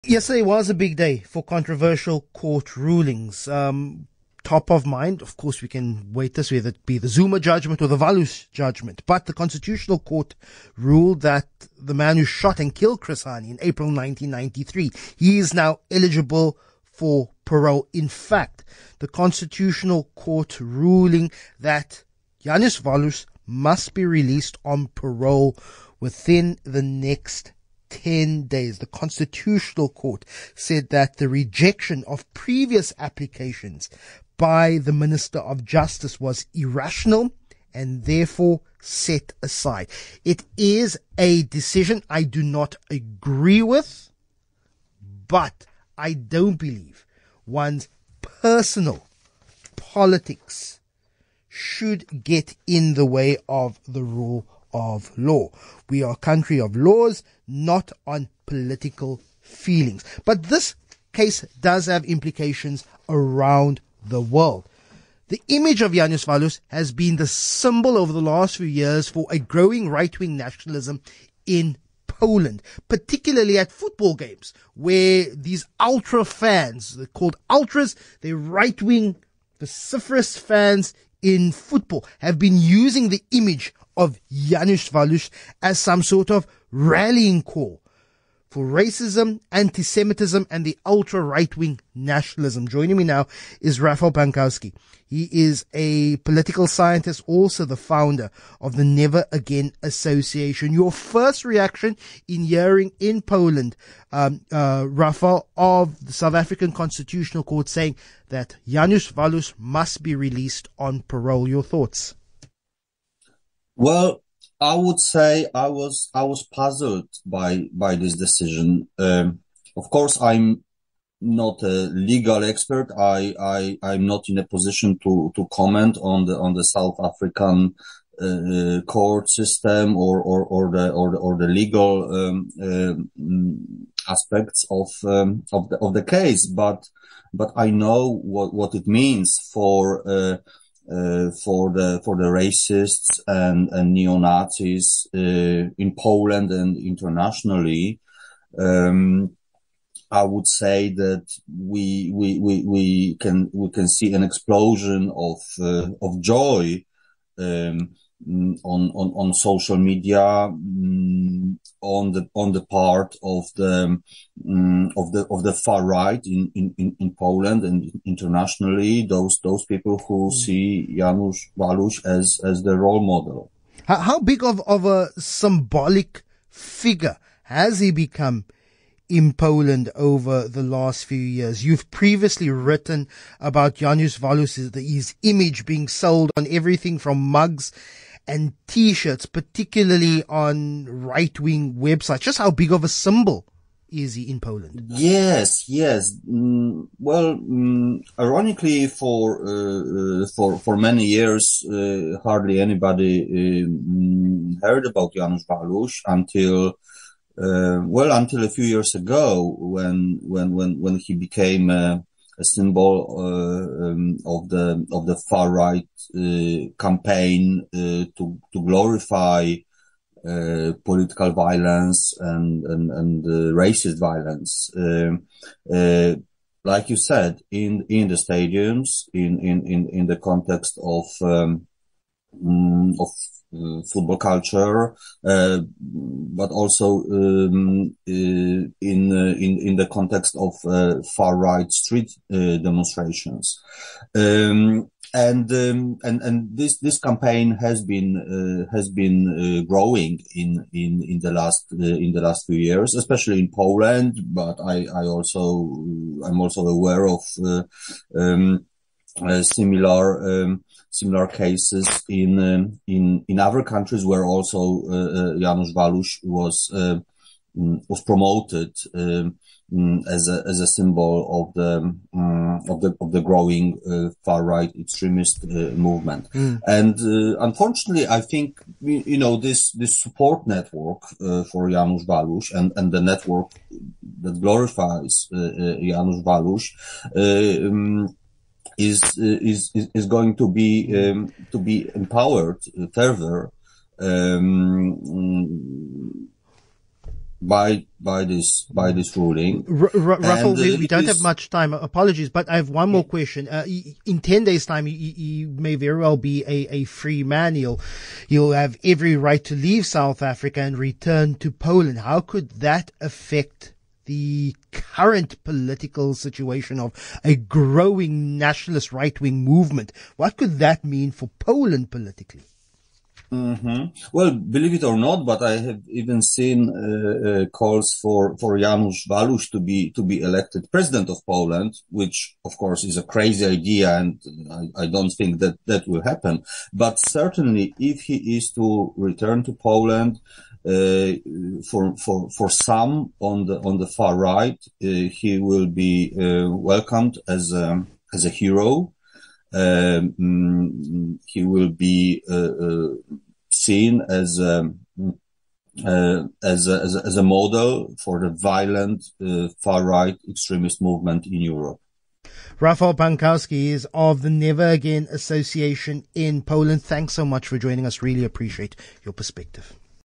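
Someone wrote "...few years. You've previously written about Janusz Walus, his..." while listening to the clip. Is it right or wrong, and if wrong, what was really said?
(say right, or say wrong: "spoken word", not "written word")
right.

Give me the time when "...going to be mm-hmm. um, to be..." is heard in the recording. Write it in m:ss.
4:50.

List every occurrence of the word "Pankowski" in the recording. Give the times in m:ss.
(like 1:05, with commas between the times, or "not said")
1:34, 6:02.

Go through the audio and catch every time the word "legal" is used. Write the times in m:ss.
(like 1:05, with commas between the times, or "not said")
2:02, 2:11.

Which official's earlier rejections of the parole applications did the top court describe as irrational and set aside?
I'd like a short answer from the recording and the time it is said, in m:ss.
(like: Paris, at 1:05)
Minister of Justice, at 0:34.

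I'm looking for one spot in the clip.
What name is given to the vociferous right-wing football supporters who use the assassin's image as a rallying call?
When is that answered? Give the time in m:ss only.
1:16.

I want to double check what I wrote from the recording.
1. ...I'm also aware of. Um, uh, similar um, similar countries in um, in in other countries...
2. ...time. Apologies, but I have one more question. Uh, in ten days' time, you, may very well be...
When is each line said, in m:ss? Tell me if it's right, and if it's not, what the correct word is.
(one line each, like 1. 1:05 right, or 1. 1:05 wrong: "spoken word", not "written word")
1. 4:16 wrong: "cases", not "countries"
2. 5:01 right.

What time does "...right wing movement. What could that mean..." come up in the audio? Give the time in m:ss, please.
5:18.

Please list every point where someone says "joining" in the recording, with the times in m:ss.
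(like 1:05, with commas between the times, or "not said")
1:32, 6:07.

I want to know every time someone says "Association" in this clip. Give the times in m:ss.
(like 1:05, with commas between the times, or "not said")
1:39, 6:05.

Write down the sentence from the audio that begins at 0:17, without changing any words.
In fact, the Constitutional Court ruling that Janusz Walus must be released on parole within the next 10 days.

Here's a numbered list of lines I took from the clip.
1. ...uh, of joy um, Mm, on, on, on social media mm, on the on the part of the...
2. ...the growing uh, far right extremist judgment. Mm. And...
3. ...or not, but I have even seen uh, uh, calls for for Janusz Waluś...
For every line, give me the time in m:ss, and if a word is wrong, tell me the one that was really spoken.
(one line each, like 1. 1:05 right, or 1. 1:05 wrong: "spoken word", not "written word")
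1. 2:35 right
2. 4:33 wrong: "movement", not "judgment"
3. 5:24 right.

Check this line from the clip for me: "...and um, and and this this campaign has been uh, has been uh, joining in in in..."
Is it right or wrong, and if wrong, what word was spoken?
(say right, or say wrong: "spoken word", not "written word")
wrong: "growing", not "joining".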